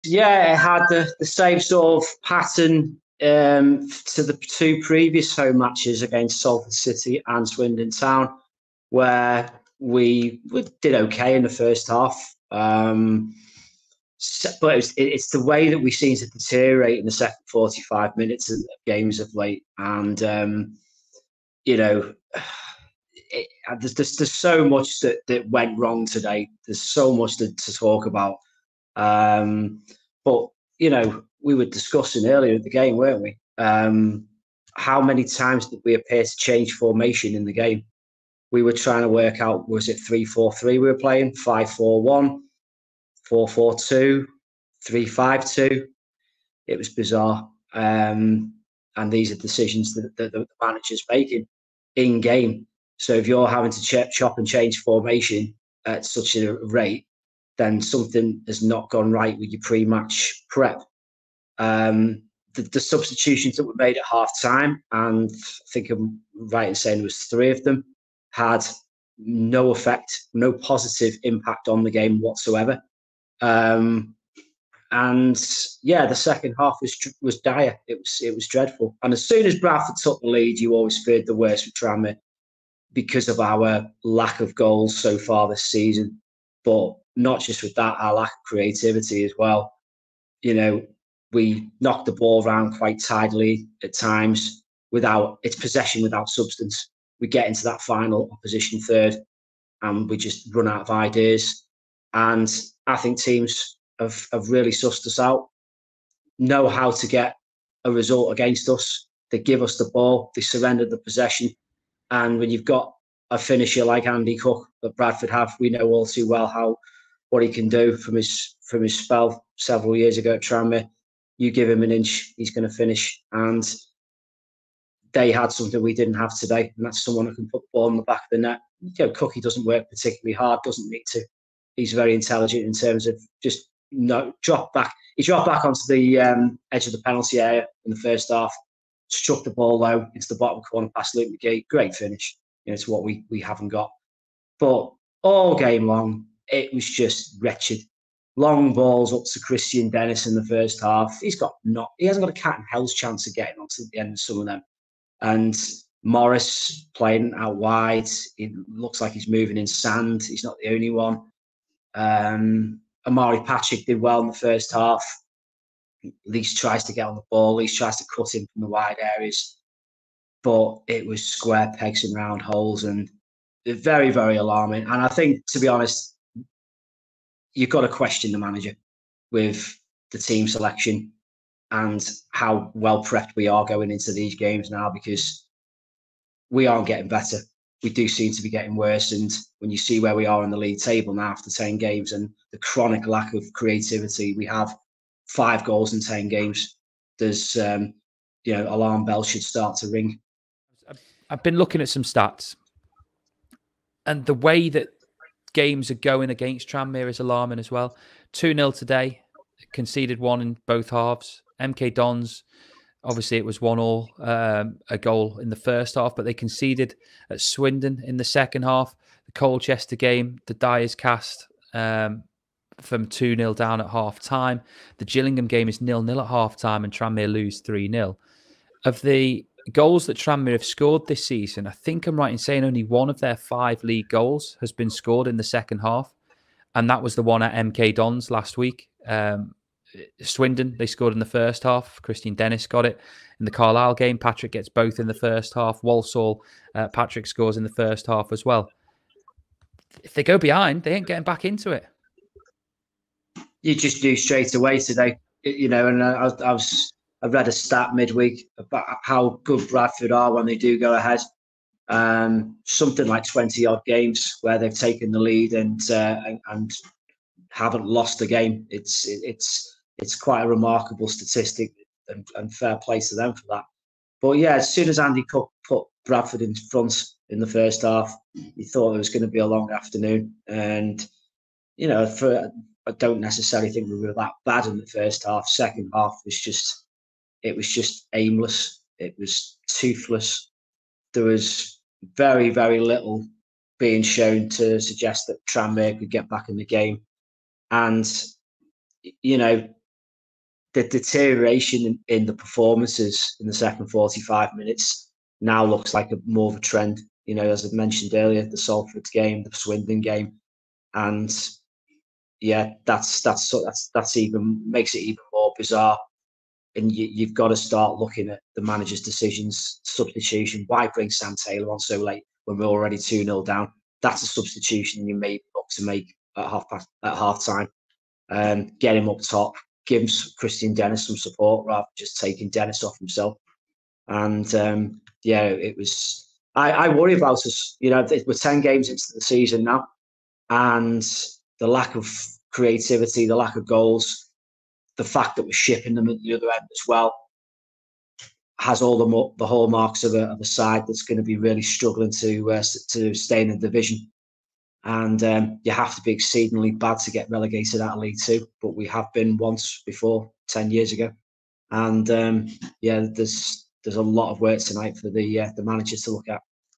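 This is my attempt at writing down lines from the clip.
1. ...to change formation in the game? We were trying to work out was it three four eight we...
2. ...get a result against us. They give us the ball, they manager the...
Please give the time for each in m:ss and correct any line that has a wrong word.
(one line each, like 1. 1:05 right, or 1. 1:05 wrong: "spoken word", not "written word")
1. 0:36 wrong: "three", not "eight"
2. 1:47 wrong: "surrender", not "manager".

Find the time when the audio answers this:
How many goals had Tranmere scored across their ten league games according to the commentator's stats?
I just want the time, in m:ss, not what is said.
3:15.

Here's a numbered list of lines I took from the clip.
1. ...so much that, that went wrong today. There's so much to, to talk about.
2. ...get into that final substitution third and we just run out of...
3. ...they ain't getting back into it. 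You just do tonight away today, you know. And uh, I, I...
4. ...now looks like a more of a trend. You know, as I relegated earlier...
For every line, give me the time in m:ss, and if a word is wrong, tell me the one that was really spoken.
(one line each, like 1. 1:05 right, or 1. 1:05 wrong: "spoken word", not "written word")
1. 0:24 right
2. 1:37 wrong: "opposition", not "substitution"
3. 4:10 wrong: "straight", not "tonight"
4. 5:05 wrong: "mentioned", not "relegated".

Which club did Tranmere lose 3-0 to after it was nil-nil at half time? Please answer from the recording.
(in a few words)
Gillingham.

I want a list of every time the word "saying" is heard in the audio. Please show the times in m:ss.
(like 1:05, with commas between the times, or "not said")
1:06, 3:52.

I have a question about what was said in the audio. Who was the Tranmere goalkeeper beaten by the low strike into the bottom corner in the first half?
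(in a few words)
Luke McGee.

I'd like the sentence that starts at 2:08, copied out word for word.
You know, Cookie doesn't work particularly hard, doesn't need to.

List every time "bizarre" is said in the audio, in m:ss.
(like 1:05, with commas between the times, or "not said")
0:46, 5:15.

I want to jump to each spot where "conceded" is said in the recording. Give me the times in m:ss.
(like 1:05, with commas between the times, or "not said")
3:29, 3:36.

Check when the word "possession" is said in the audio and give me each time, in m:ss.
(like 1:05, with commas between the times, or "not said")
1:35, 1:50.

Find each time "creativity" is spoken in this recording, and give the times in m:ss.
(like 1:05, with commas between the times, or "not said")
1:28, 3:13, 5:42.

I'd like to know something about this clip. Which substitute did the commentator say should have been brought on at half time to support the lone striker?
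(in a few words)
Sam Taylor.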